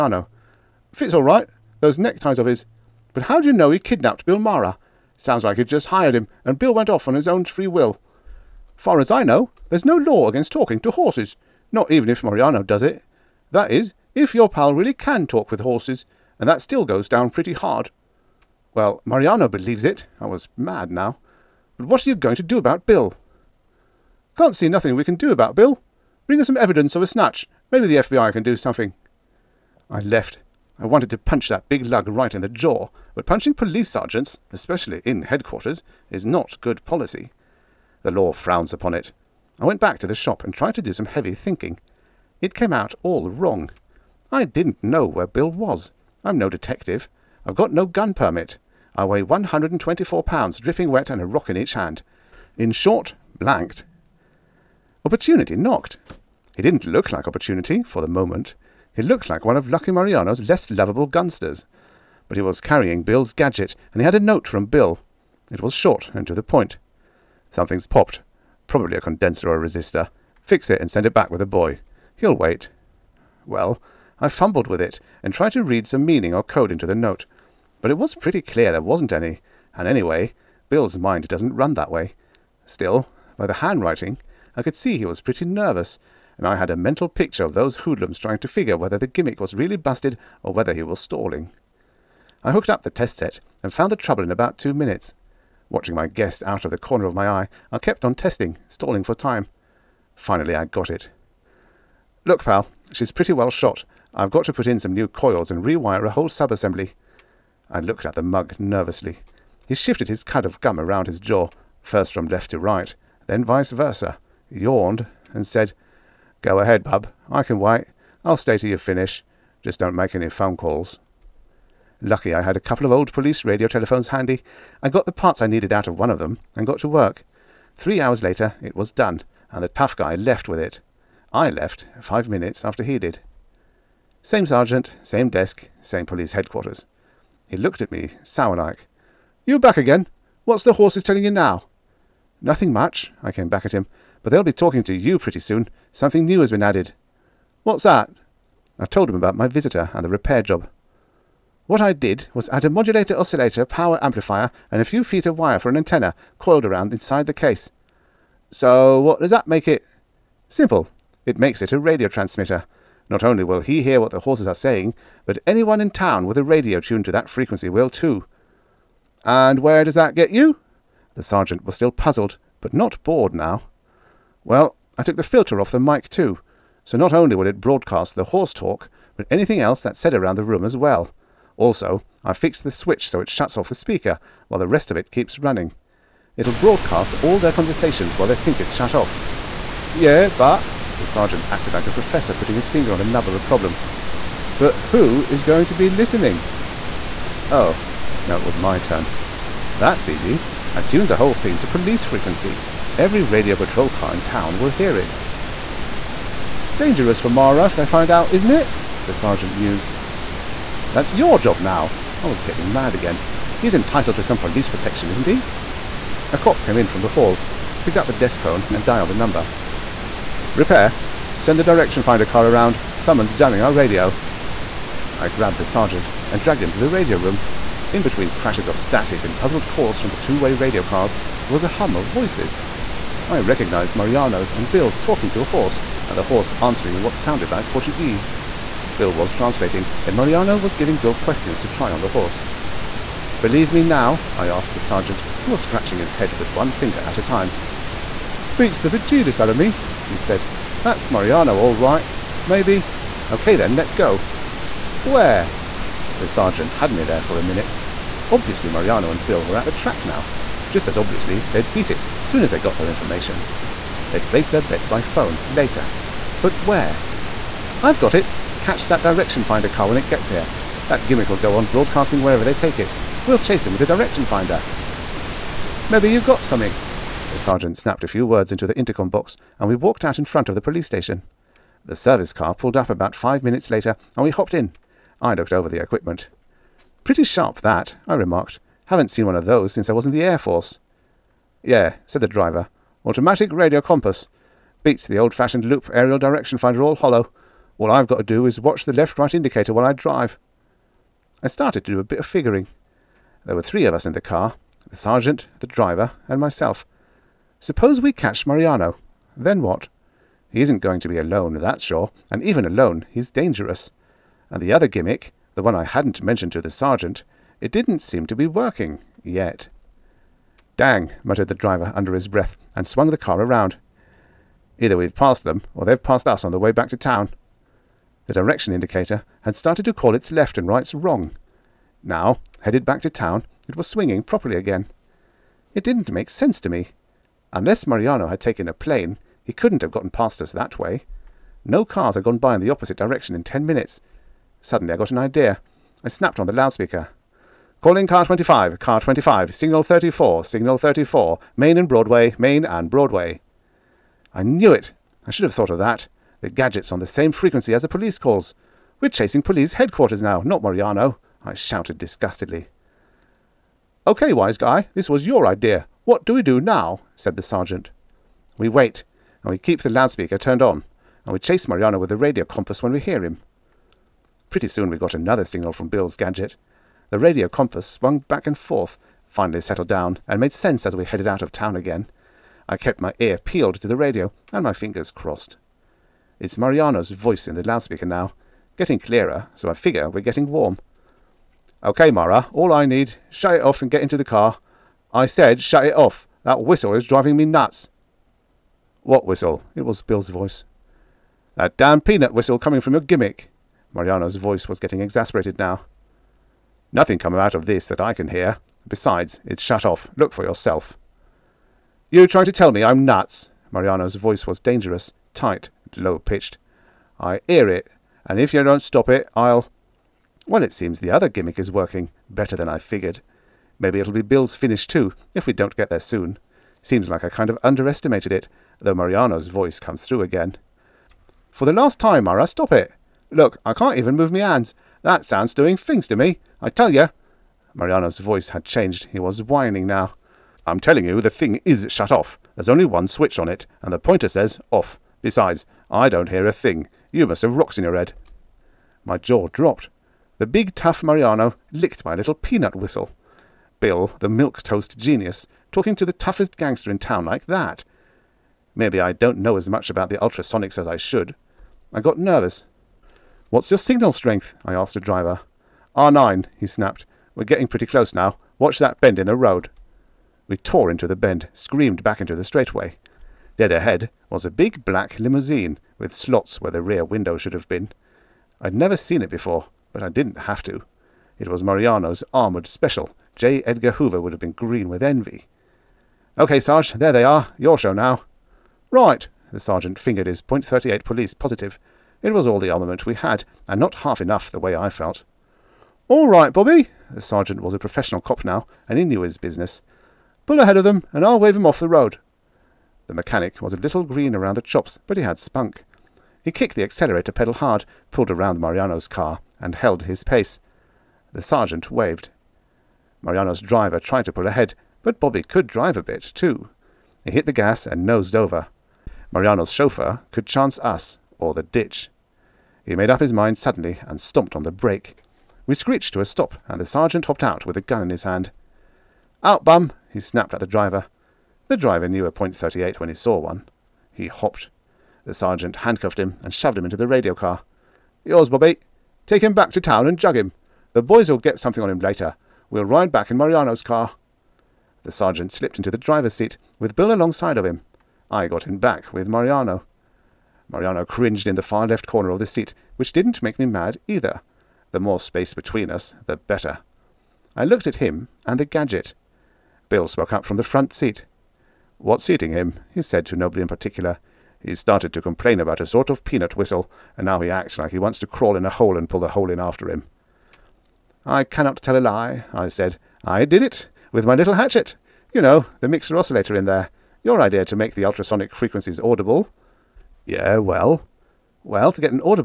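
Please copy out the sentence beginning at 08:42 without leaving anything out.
He made up his mind suddenly and stomped on the brake.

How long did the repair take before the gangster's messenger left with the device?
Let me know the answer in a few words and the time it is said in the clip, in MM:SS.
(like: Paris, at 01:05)
3 hours, at 02:07.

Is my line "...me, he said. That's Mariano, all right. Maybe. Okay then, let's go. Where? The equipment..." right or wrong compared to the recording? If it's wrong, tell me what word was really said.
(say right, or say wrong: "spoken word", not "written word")
wrong: "sergeant", not "equipment".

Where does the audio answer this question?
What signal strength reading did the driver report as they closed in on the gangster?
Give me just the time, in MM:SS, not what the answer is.
07:45.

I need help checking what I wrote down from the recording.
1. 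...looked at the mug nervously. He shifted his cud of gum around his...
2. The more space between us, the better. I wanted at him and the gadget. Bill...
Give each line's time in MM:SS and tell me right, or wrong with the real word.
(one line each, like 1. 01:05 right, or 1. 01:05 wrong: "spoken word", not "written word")
1. 01:47 right
2. 09:14 wrong: "looked", not "wanted".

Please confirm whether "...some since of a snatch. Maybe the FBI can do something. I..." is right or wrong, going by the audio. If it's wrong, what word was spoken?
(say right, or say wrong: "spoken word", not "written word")
wrong: "evidence", not "since".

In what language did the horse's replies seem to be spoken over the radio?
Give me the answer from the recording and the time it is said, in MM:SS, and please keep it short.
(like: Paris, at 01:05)
Portuguese, at 03:57.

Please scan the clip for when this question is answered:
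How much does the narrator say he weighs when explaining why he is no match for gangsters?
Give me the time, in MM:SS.
00:49.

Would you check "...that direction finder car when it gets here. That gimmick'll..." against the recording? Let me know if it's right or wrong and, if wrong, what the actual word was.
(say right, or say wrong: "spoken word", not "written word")
right.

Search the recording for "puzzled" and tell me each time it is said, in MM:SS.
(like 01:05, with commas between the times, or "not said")
02:51, 03:49.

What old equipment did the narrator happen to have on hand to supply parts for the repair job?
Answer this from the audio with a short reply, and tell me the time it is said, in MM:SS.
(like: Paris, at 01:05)
police radio telephones, at 02:03.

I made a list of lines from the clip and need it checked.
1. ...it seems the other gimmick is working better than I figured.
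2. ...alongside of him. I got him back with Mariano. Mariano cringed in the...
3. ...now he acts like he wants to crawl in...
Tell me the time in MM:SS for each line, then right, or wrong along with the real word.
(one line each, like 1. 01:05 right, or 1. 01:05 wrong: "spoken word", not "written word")
1. 07:00 right
2. 09:07 right
3. 09:27 right.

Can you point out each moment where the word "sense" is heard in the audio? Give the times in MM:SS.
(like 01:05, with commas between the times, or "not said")
05:36, 06:20.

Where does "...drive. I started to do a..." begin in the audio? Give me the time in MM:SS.
04:59.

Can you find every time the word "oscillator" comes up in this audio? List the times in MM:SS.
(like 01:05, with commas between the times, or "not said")
02:33, 09:36.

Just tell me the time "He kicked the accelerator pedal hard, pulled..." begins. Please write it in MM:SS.
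08:26.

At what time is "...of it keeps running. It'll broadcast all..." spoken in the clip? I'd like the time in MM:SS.
03:04.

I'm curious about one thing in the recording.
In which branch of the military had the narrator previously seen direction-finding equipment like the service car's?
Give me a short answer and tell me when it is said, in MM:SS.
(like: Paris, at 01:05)
Air Force, at 04:50.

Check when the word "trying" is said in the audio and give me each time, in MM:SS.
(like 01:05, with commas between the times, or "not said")
01:28, 06:52.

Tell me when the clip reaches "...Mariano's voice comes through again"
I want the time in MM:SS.
07:08.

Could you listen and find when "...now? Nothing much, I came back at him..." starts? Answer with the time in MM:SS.
02:21.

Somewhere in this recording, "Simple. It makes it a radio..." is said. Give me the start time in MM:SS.
02:40.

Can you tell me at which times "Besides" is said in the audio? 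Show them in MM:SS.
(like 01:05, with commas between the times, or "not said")
06:48, 07:25.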